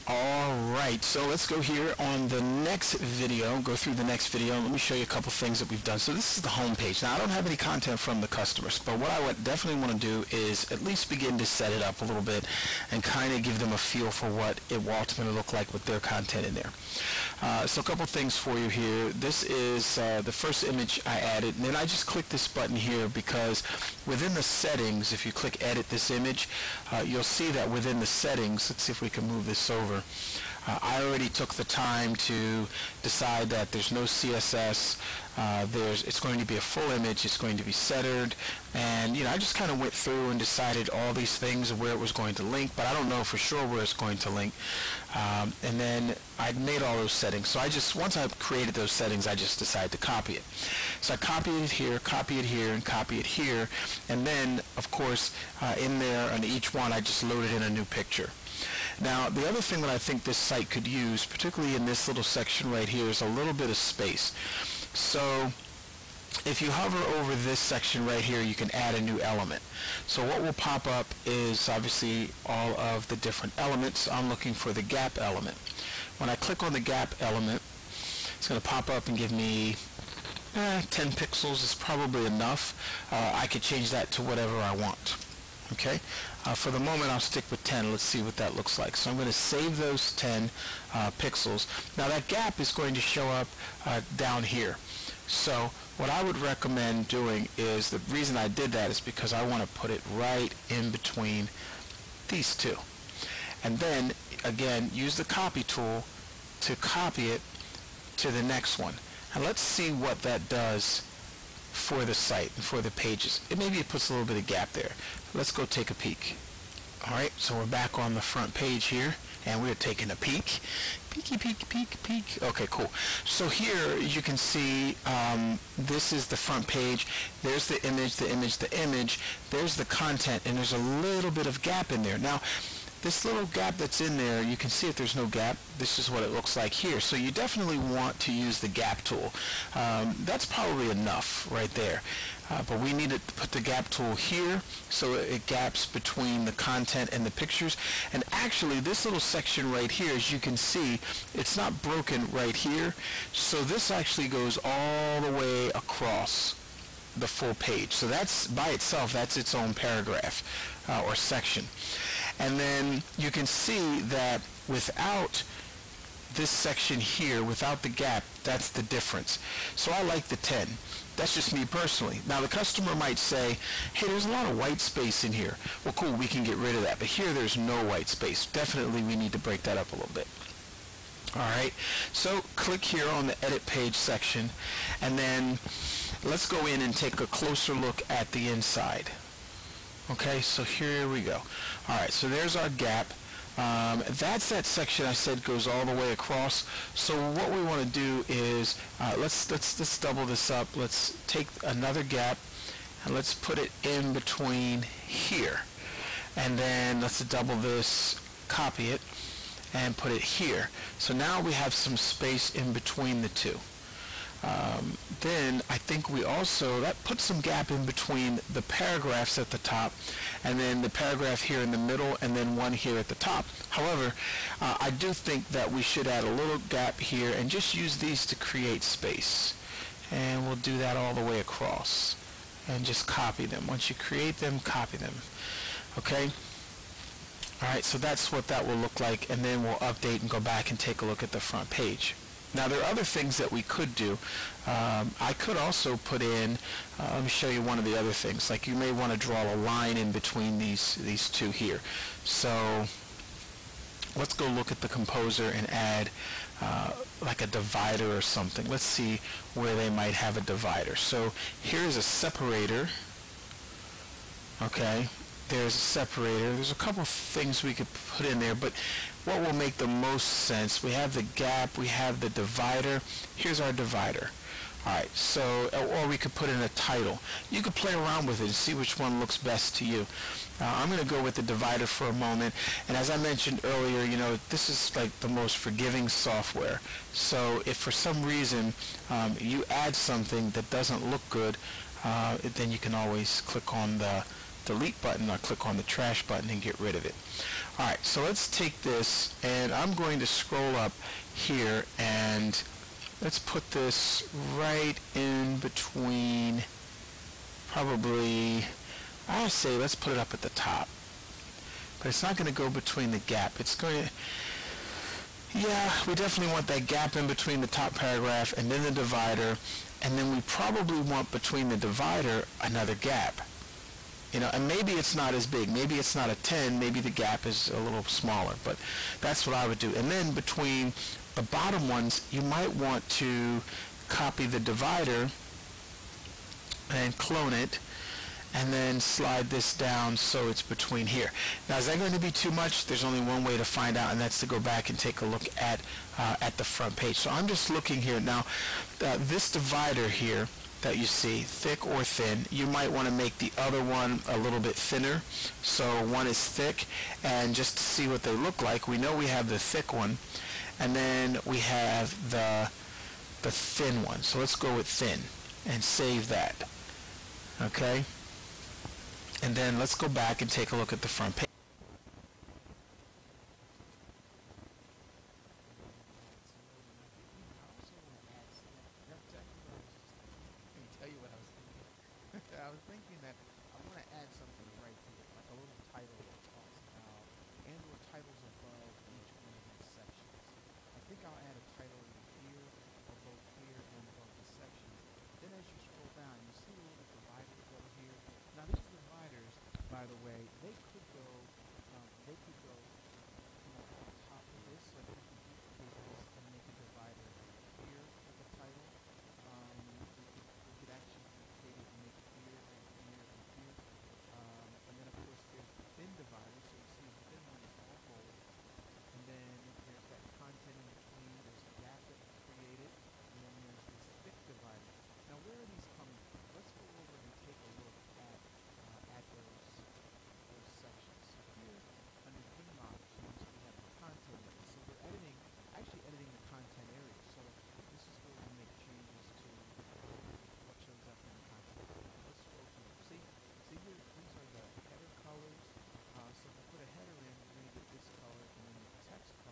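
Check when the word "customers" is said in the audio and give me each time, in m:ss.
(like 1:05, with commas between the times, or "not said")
0:08, 2:52.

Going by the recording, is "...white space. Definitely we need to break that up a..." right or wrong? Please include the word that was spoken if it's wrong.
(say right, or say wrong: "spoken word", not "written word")
right.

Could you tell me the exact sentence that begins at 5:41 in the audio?
Now is that going to be too much?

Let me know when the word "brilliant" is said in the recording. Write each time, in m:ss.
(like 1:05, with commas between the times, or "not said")
not said.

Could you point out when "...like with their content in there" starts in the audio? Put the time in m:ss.
0:15.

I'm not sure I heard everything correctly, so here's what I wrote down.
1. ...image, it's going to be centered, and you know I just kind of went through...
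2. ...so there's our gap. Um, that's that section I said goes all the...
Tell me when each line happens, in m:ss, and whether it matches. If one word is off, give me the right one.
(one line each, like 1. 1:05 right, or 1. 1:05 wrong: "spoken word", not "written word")
1. 0:36 right
2. 3:12 right.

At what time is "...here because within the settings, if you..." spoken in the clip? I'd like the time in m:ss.
0:22.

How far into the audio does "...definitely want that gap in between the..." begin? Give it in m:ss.
5:16.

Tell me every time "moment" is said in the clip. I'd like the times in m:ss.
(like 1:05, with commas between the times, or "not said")
1:26, 4:42.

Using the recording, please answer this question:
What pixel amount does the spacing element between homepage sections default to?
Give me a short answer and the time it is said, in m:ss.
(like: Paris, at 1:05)
10 pixels, at 1:20.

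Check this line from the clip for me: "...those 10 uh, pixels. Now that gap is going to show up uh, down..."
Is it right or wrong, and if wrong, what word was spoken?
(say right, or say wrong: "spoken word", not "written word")
right.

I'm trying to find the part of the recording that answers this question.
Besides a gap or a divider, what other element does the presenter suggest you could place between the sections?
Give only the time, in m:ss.
4:36.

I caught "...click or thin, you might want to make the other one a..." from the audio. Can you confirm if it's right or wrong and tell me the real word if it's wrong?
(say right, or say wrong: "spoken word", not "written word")
wrong: "thick", not "click".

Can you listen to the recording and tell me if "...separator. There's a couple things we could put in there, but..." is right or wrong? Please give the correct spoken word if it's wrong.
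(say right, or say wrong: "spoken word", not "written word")
right.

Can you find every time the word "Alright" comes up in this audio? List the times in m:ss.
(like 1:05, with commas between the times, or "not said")
3:57, 4:57.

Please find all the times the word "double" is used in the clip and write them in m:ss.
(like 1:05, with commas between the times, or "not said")
3:19, 3:27.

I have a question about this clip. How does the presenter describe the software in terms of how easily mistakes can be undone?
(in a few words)
most forgiving software.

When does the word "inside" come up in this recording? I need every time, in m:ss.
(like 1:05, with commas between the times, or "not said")
3:08.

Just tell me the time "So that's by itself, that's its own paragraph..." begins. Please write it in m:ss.
2:37.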